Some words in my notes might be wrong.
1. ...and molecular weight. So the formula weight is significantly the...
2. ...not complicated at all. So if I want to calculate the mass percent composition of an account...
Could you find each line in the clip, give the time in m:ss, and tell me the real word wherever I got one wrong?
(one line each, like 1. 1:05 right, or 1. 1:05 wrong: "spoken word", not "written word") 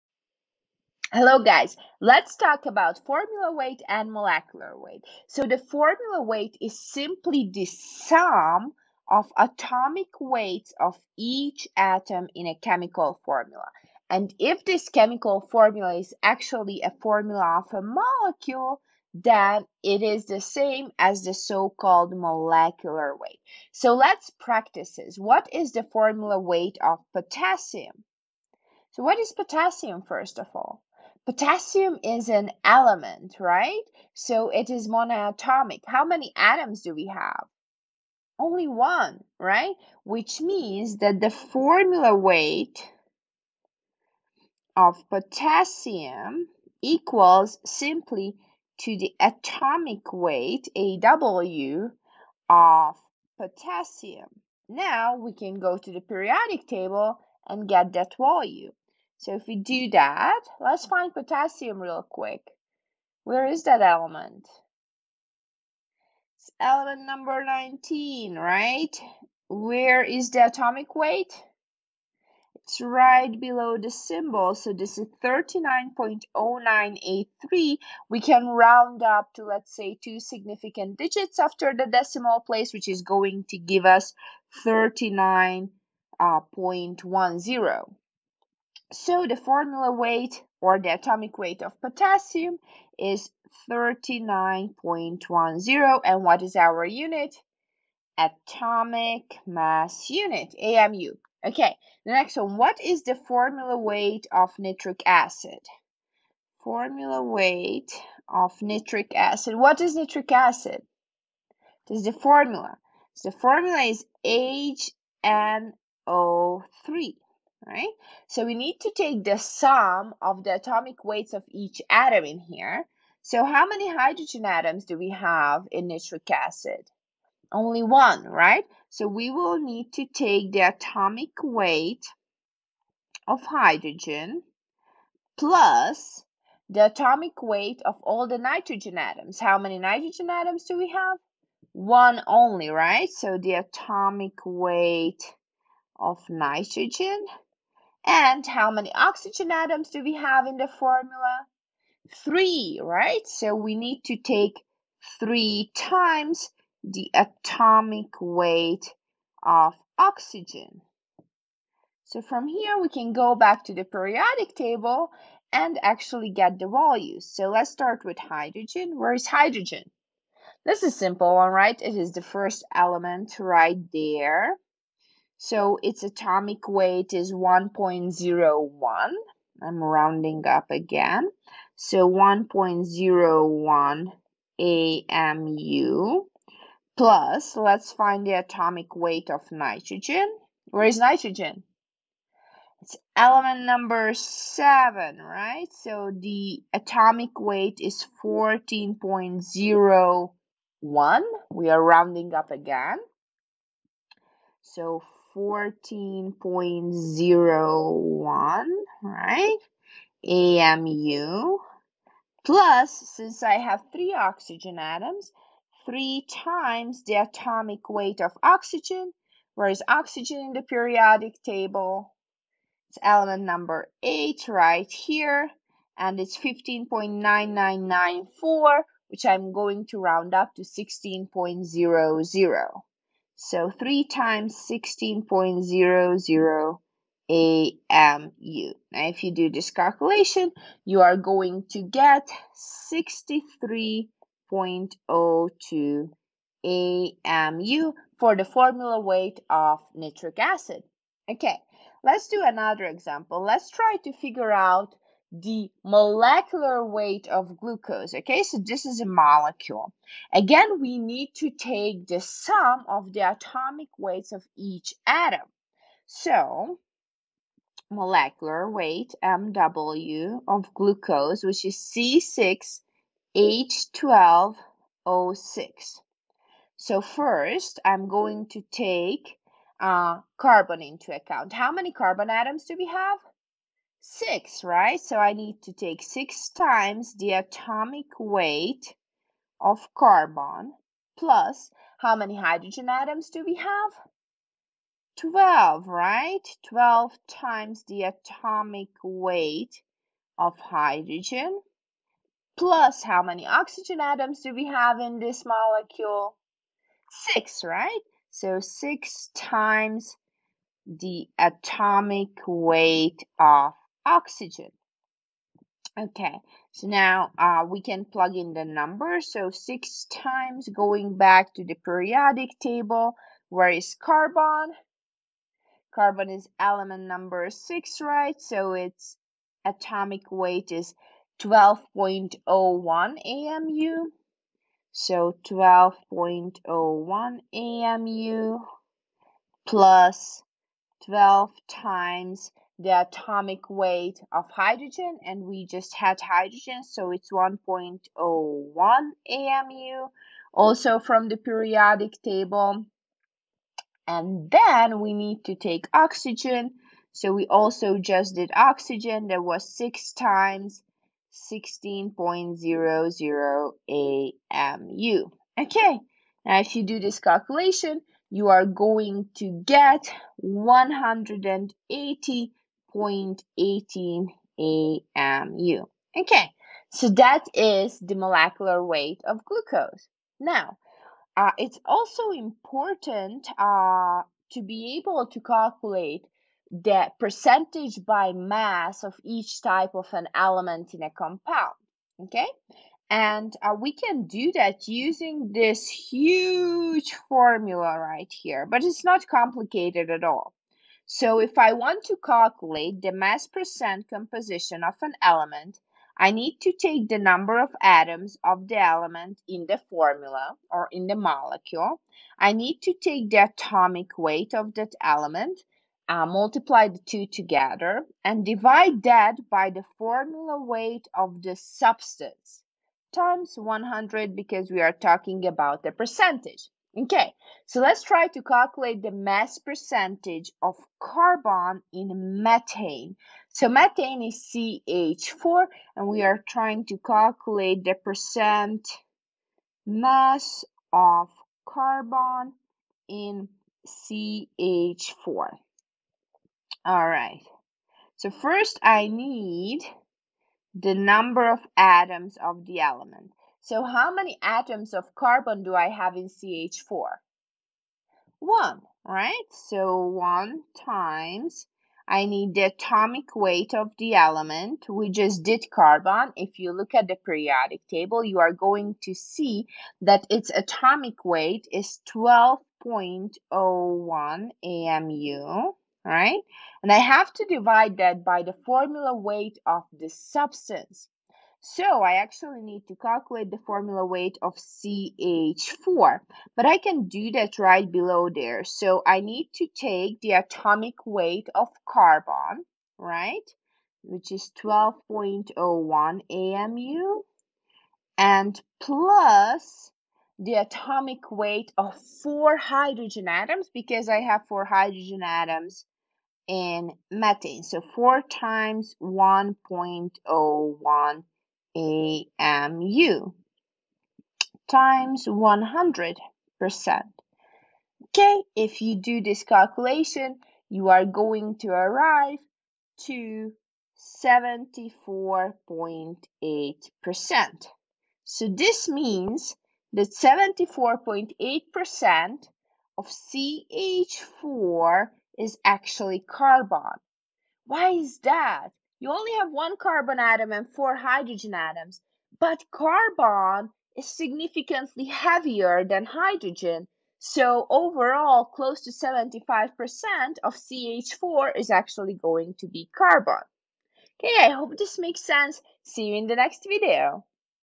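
1. 0:03 wrong: "simply", not "significantly"
2. 6:39 wrong: "element", not "account".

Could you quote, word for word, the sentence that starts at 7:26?
All right, so first I need the number of atoms of the element.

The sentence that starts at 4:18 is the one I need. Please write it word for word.
Okay, so this is a molecule.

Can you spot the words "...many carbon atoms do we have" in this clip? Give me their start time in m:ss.
4:41.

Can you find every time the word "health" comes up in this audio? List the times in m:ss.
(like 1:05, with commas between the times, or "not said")
not said.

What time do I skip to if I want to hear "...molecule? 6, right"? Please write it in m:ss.
5:05.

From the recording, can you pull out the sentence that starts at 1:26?
Uh, so the formula weight or the atomic weight of potassium is 39.10 and what is our unit?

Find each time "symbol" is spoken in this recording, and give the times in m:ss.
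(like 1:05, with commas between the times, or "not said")
1:13.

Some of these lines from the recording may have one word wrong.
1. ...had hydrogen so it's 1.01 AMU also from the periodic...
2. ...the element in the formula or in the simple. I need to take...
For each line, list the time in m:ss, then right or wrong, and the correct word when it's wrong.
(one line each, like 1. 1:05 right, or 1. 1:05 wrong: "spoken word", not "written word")
1. 5:45 right
2. 6:48 wrong: "molecule", not "simple".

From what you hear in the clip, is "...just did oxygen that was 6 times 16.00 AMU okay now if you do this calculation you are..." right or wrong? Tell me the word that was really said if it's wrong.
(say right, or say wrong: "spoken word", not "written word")
right.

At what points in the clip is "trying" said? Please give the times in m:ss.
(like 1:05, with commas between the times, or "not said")
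7:16.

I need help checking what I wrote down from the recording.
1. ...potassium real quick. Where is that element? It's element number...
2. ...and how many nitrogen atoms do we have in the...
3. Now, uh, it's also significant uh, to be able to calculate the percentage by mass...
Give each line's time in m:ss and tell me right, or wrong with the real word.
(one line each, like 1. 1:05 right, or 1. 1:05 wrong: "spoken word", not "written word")
1. 1:01 right
2. 2:28 wrong: "oxygen", not "nitrogen"
3. 6:20 wrong: "important", not "significant".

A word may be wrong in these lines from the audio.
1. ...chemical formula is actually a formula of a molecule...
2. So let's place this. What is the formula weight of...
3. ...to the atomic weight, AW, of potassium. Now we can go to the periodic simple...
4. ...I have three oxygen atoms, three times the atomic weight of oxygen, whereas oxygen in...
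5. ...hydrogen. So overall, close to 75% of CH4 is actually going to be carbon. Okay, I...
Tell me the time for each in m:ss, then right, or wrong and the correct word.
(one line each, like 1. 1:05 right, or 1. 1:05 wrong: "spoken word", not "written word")
1. 0:14 right
2. 0:23 wrong: "practice", not "place"
3. 0:48 wrong: "table", not "simple"
4. 3:33 right
5. 9:06 right.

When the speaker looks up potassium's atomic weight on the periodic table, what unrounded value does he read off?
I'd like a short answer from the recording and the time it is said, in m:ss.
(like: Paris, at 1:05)
39.0983, at 1:15.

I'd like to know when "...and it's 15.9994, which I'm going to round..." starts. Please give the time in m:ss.
3:45.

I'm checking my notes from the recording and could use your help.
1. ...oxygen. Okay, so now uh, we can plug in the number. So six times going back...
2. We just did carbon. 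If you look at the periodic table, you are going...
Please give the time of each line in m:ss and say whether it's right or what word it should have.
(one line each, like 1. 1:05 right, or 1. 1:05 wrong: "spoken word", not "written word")
1. 5:14 right
2. 7:44 right.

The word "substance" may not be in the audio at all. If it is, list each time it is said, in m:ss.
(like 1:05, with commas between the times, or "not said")
7:01, 8:00.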